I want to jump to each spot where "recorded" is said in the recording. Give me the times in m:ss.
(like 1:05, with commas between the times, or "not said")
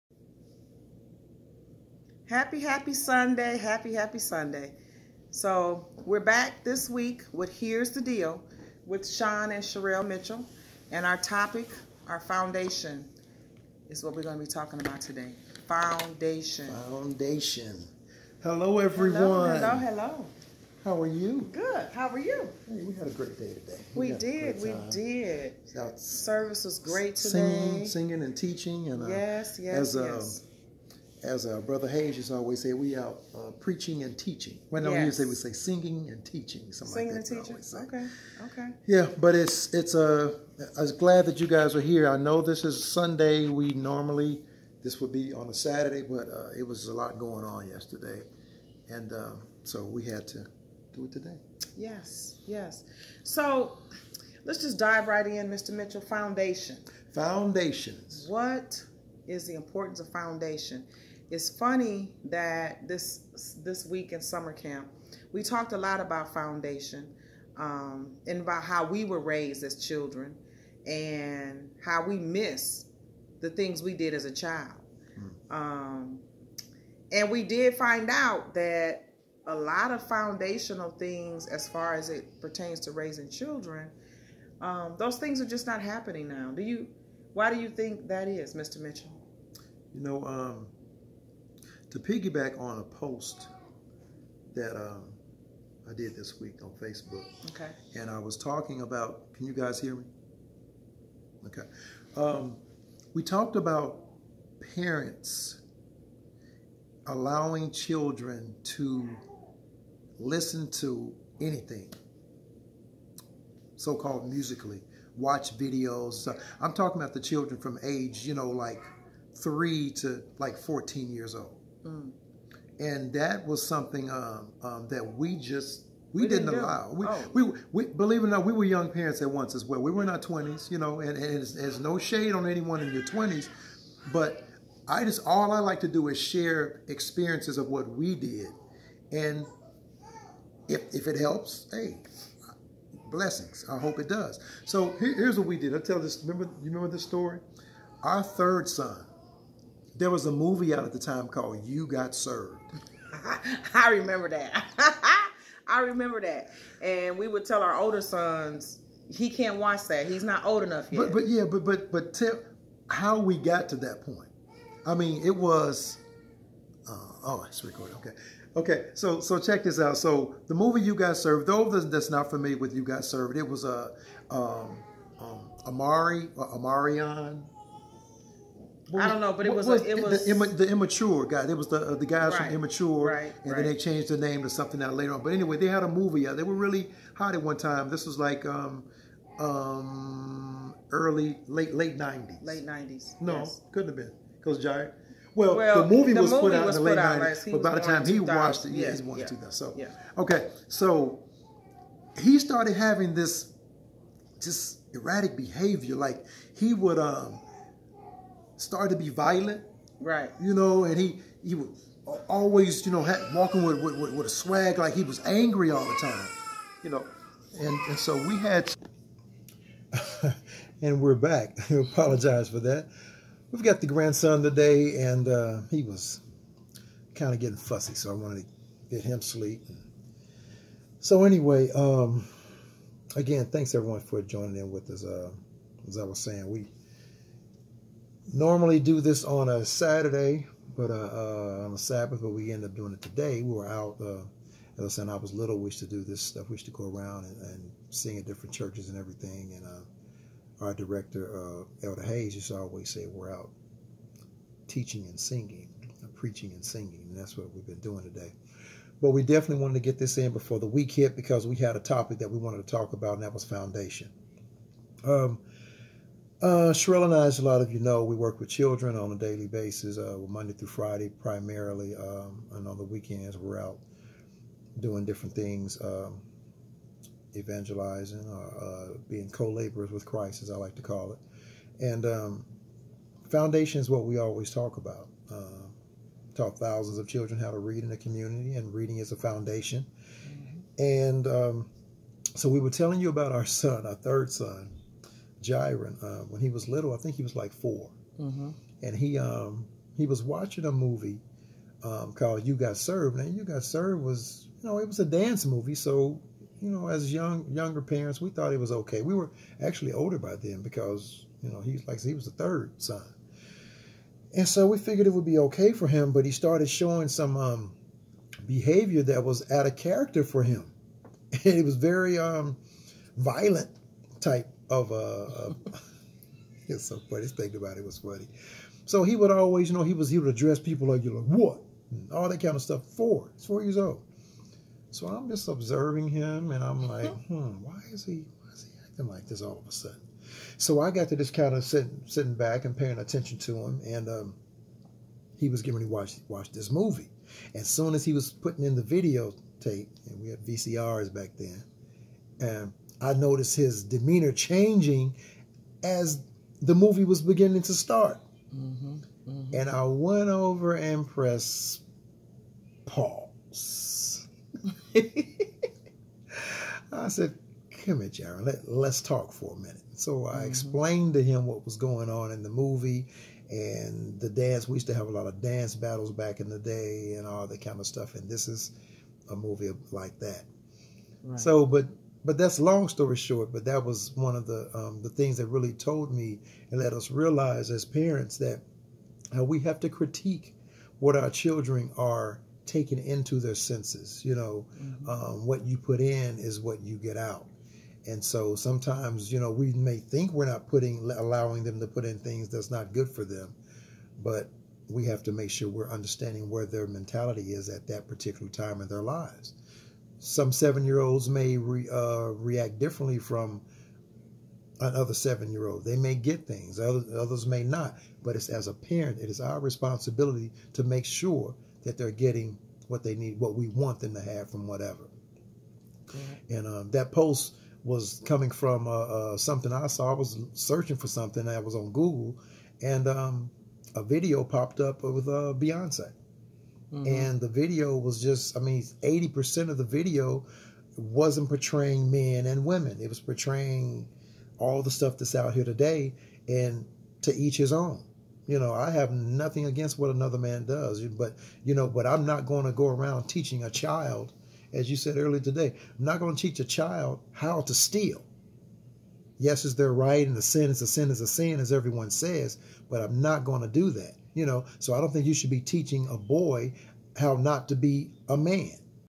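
2:47.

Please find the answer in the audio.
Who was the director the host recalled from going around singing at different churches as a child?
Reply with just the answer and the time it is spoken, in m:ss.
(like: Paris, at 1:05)
Elder Hayes, at 4:11.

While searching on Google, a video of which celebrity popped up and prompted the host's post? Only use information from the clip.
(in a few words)
Beyonce.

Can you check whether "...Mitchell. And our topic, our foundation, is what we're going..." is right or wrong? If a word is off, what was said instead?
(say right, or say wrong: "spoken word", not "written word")
right.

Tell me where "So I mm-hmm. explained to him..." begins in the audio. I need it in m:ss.
6:09.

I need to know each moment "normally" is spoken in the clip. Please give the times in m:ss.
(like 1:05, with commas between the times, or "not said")
0:43, 3:58.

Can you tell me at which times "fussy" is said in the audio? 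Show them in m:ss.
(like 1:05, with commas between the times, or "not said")
3:47.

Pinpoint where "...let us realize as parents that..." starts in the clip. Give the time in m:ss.
6:26.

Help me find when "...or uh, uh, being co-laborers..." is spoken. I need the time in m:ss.
4:38.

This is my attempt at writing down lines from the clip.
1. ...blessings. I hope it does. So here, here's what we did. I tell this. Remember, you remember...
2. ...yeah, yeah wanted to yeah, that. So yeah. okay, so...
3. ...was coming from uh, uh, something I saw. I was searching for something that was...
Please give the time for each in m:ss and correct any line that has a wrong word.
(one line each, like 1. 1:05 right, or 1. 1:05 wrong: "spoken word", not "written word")
1. 2:23 right
2. 3:18 right
3. 7:07 right.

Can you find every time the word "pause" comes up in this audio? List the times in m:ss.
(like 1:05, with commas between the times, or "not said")
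6:02.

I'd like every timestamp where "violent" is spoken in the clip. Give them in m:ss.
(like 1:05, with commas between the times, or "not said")
3:29, 5:23.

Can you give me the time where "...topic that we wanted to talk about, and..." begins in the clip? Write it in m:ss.
4:21.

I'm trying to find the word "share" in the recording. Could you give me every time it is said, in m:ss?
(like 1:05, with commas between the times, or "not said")
2:16.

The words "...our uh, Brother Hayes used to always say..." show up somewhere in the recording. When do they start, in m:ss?
0:31.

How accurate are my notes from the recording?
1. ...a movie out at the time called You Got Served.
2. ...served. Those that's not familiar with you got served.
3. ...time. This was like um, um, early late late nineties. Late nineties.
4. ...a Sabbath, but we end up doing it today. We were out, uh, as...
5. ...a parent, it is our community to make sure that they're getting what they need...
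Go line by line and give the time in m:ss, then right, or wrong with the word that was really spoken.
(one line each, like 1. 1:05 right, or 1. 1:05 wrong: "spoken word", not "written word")
1. 2:30 right
2. 2:51 right
3. 3:07 right
4. 4:01 right
5. 6:58 wrong: "responsibility", not "community".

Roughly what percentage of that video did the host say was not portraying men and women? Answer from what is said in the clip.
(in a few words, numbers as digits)
80%.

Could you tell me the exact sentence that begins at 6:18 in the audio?
And this is a movie like that.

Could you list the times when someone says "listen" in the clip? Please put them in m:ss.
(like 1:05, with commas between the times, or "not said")
1:50.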